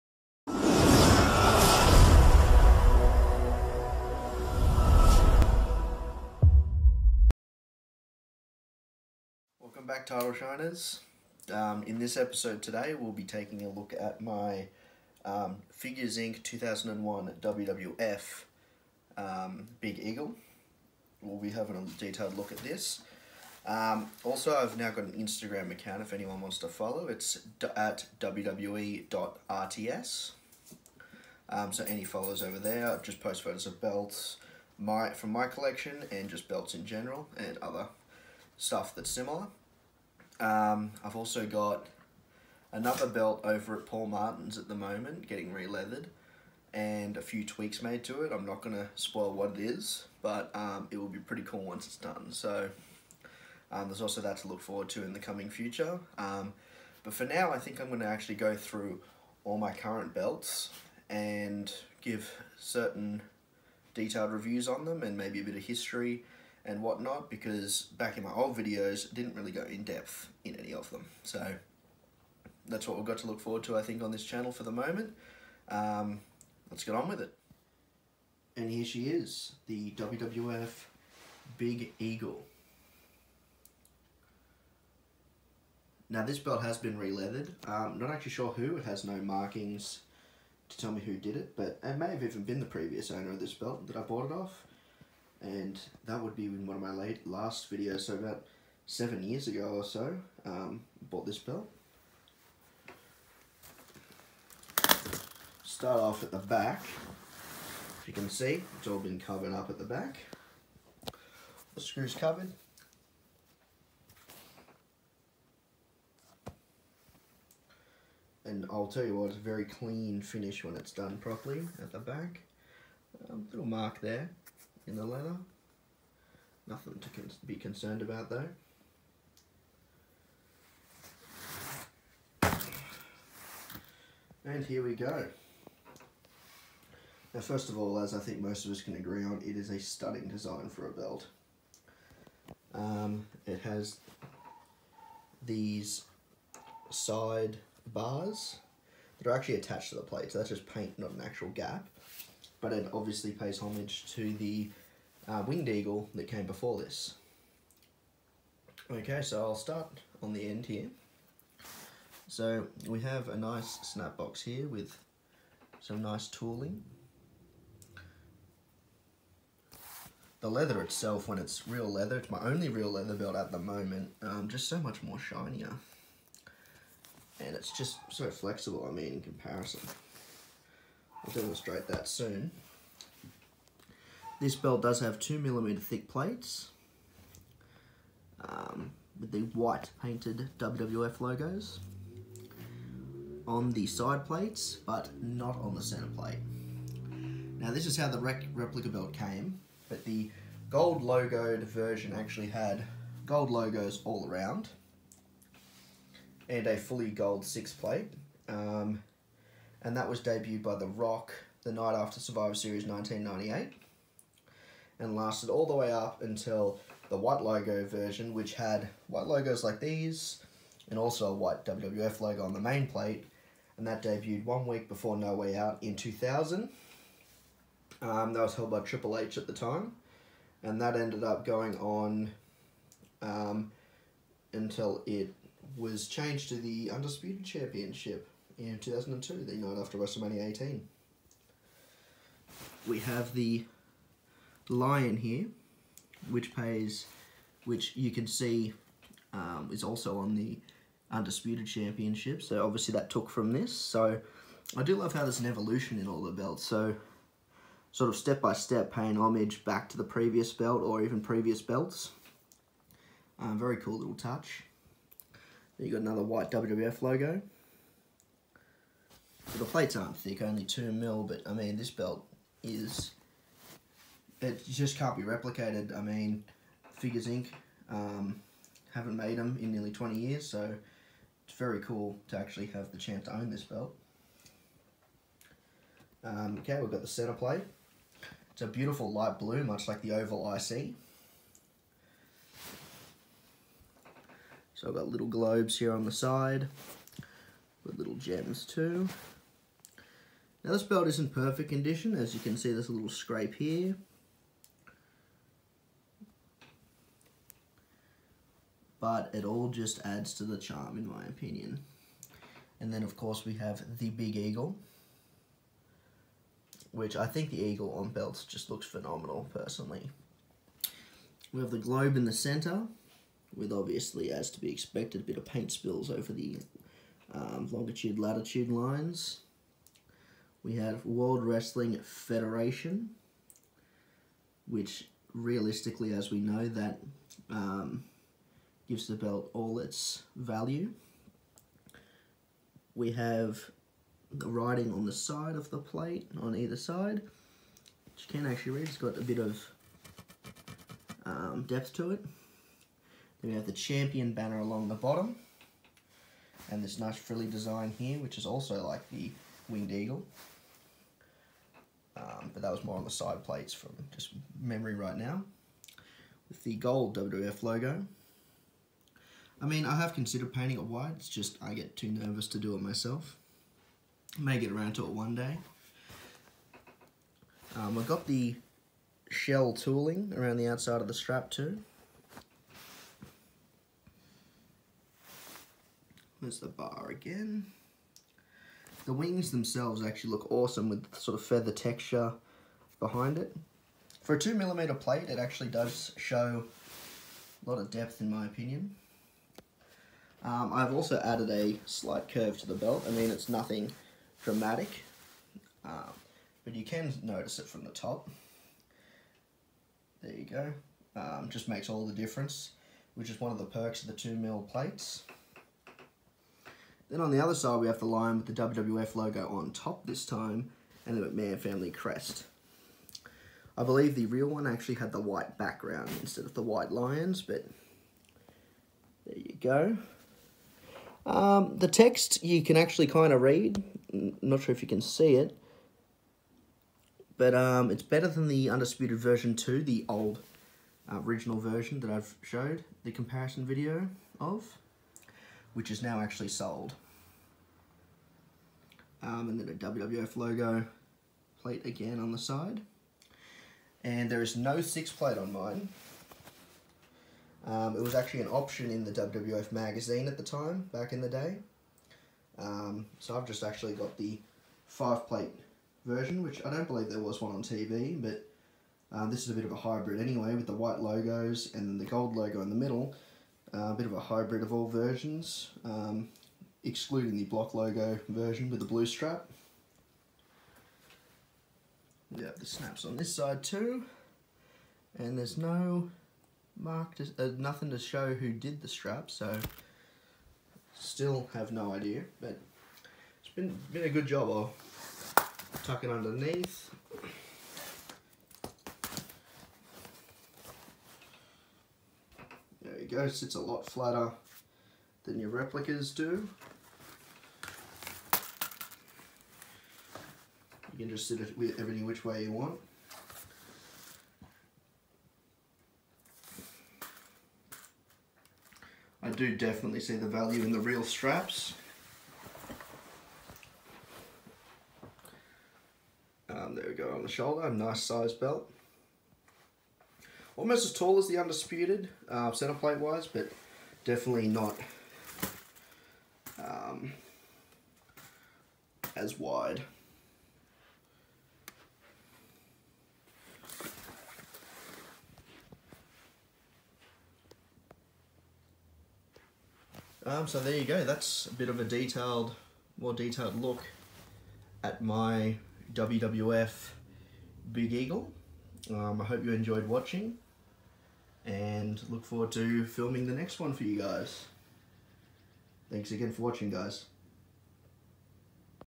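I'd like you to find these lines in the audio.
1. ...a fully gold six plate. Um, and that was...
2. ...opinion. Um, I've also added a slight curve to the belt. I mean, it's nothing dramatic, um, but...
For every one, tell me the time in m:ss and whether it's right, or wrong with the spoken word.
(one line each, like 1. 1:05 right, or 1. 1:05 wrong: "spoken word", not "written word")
1. 3:26 right
2. 6:38 right.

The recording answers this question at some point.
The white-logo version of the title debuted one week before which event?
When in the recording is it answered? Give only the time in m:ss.
3:45.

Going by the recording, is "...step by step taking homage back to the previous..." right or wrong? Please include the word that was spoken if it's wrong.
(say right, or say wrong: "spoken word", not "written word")
wrong: "paying", not "taking".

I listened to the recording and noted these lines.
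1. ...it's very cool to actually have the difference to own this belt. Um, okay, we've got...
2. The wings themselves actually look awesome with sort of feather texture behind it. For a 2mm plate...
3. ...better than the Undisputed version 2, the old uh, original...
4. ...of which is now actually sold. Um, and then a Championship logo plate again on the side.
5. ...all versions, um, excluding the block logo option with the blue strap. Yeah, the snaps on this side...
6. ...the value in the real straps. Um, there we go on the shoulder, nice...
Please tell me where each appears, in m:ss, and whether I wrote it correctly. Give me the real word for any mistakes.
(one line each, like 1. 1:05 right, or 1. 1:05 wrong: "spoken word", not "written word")
1. 4:41 wrong: "chance", not "difference"
2. 6:29 right
3. 7:18 right
4. 7:24 wrong: "WWF", not "Championship"
5. 7:54 wrong: "version", not "option"
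6. 8:40 right.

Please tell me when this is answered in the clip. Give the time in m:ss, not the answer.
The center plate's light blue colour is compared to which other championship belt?
4:50.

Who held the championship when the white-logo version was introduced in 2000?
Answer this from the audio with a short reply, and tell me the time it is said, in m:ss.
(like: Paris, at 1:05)
Triple H, at 3:48.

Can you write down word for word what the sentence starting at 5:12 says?
And then of course we have the Big Eagle.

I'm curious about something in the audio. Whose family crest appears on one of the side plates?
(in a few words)
McMahon.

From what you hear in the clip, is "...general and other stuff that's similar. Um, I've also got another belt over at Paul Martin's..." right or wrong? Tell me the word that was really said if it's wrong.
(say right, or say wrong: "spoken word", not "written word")
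right.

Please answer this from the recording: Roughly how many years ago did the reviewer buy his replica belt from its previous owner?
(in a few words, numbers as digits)
7.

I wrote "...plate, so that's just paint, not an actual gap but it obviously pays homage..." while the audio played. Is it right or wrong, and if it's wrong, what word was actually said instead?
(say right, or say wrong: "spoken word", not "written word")
right.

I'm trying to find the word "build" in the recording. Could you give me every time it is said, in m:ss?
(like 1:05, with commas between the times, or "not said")
not said.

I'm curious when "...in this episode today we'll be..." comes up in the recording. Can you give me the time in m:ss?
0:11.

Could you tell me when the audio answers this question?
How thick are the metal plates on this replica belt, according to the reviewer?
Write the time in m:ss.
3:05.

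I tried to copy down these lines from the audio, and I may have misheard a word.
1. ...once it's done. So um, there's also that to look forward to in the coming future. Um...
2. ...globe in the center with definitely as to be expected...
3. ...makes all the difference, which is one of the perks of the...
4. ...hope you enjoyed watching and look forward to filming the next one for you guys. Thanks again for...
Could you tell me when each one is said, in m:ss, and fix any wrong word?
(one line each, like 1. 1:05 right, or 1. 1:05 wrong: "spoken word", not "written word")
1. 0:51 right
2. 5:21 wrong: "obviously", not "definitely"
3. 6:51 right
4. 9:19 right.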